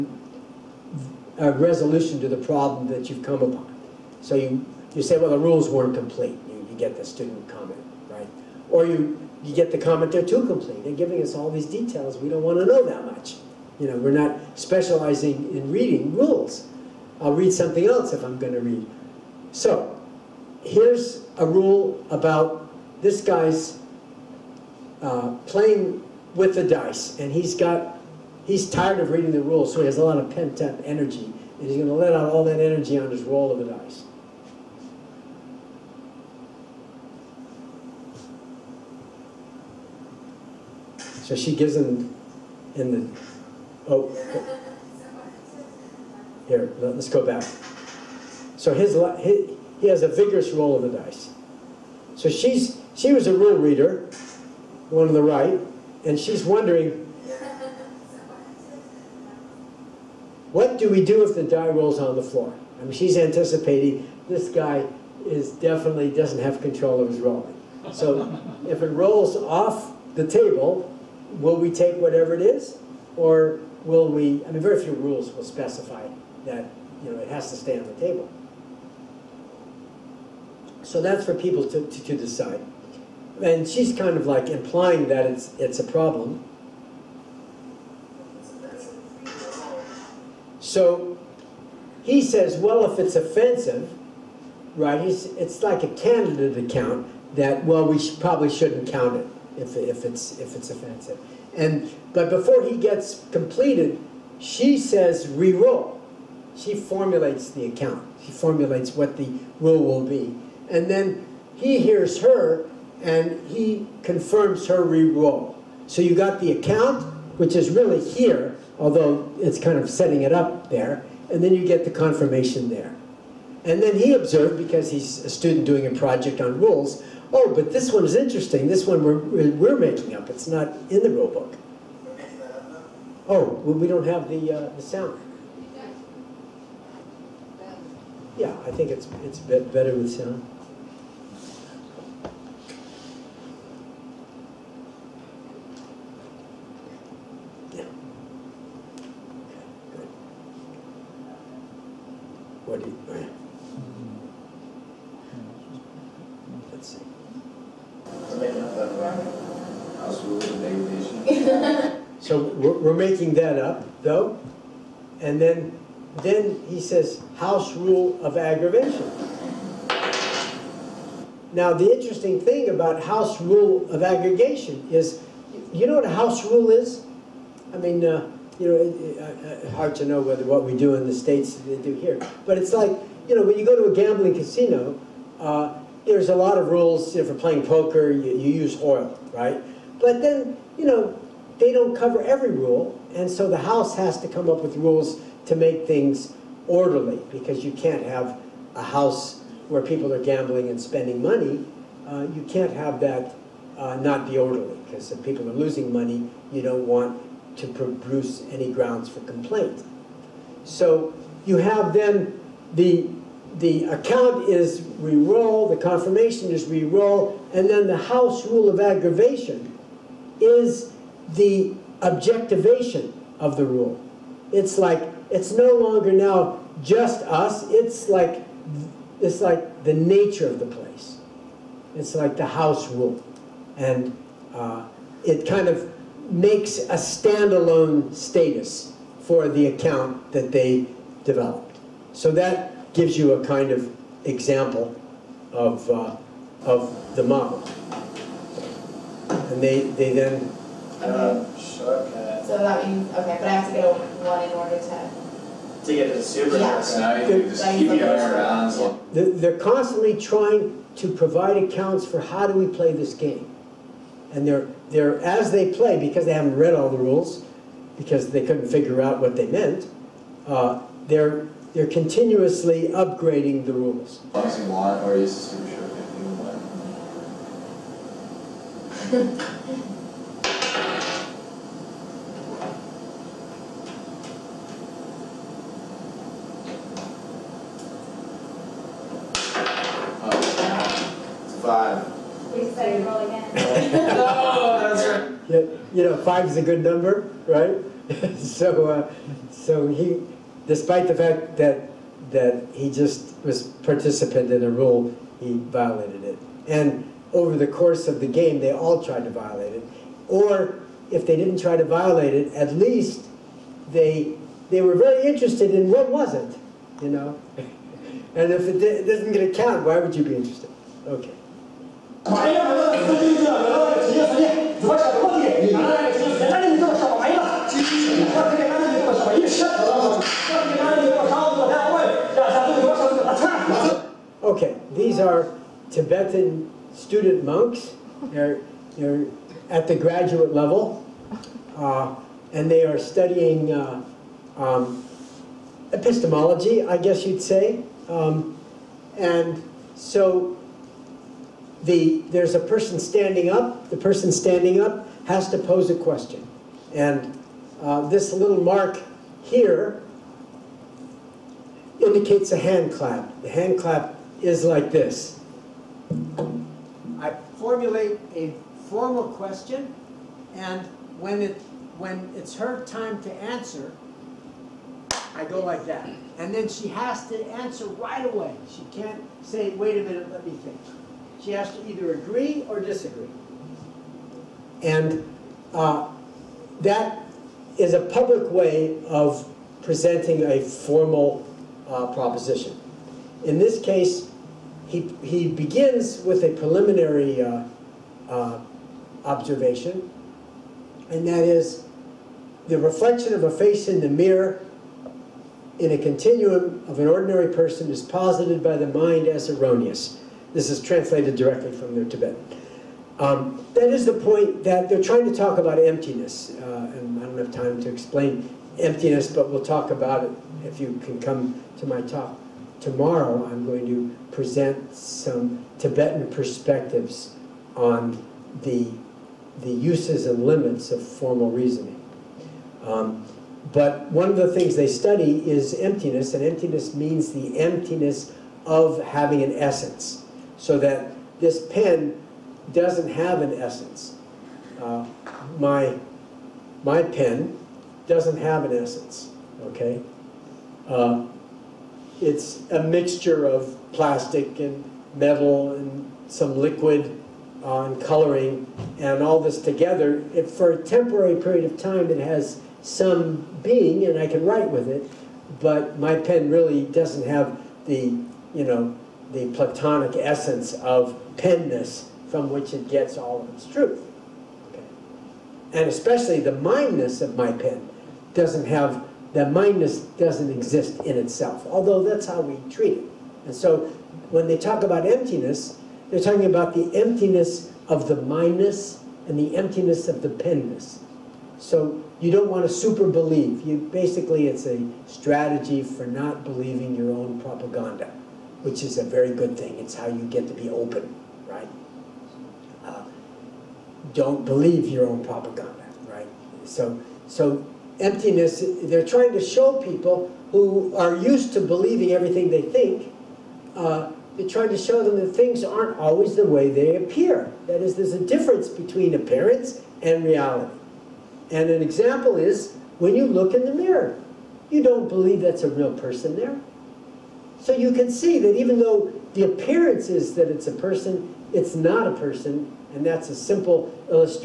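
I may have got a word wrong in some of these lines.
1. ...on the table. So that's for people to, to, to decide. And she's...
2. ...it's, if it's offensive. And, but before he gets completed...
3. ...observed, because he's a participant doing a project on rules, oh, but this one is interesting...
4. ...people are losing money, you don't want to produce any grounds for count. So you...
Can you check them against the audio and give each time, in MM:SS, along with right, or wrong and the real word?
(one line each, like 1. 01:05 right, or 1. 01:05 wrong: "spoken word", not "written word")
1. 01:17 right
2. 01:40 right
3. 02:04 wrong: "student", not "participant"
4. 03:25 wrong: "complaint", not "count".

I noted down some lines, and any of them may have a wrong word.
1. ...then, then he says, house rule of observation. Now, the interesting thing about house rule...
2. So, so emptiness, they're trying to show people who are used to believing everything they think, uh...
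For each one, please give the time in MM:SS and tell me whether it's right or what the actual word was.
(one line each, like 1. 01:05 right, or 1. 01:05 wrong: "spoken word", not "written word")
1. 02:45 wrong: "aggravation", not "observation"
2. 08:26 right.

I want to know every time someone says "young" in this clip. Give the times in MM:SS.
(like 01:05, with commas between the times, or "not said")
not said.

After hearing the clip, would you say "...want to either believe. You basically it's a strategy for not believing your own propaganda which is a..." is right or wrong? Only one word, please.
wrong.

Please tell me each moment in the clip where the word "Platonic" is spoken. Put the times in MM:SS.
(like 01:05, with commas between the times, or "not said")
07:49.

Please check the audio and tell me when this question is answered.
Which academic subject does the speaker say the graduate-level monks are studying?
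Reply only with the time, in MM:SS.
05:45.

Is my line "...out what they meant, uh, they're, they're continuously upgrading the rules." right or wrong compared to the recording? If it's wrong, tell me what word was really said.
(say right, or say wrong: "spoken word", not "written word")
right.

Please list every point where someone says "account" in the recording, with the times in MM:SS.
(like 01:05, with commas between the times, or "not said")
01:36, 01:47, 01:56, 03:33, 03:59, 04:21.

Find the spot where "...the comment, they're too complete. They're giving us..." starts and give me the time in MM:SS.
00:09.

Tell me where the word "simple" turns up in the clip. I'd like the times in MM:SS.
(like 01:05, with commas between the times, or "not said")
08:53.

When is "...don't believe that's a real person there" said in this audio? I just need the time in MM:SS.
08:44.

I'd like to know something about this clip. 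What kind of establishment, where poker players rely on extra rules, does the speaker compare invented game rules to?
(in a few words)
Gambling casino.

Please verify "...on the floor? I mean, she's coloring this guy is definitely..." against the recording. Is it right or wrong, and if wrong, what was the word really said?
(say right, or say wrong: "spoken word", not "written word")
wrong: "anticipating", not "coloring".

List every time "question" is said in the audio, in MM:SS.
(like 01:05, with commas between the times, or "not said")
05:55, 06:09.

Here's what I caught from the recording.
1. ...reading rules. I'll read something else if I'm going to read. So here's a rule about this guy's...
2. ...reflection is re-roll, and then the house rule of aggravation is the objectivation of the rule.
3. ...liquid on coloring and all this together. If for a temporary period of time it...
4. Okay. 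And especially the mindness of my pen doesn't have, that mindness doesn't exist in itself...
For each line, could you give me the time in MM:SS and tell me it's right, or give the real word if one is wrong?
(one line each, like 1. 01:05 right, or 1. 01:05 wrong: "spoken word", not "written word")
1. 00:15 right
2. 03:35 wrong: "confirmation", not "reflection"
3. 07:36 right
4. 07:54 right.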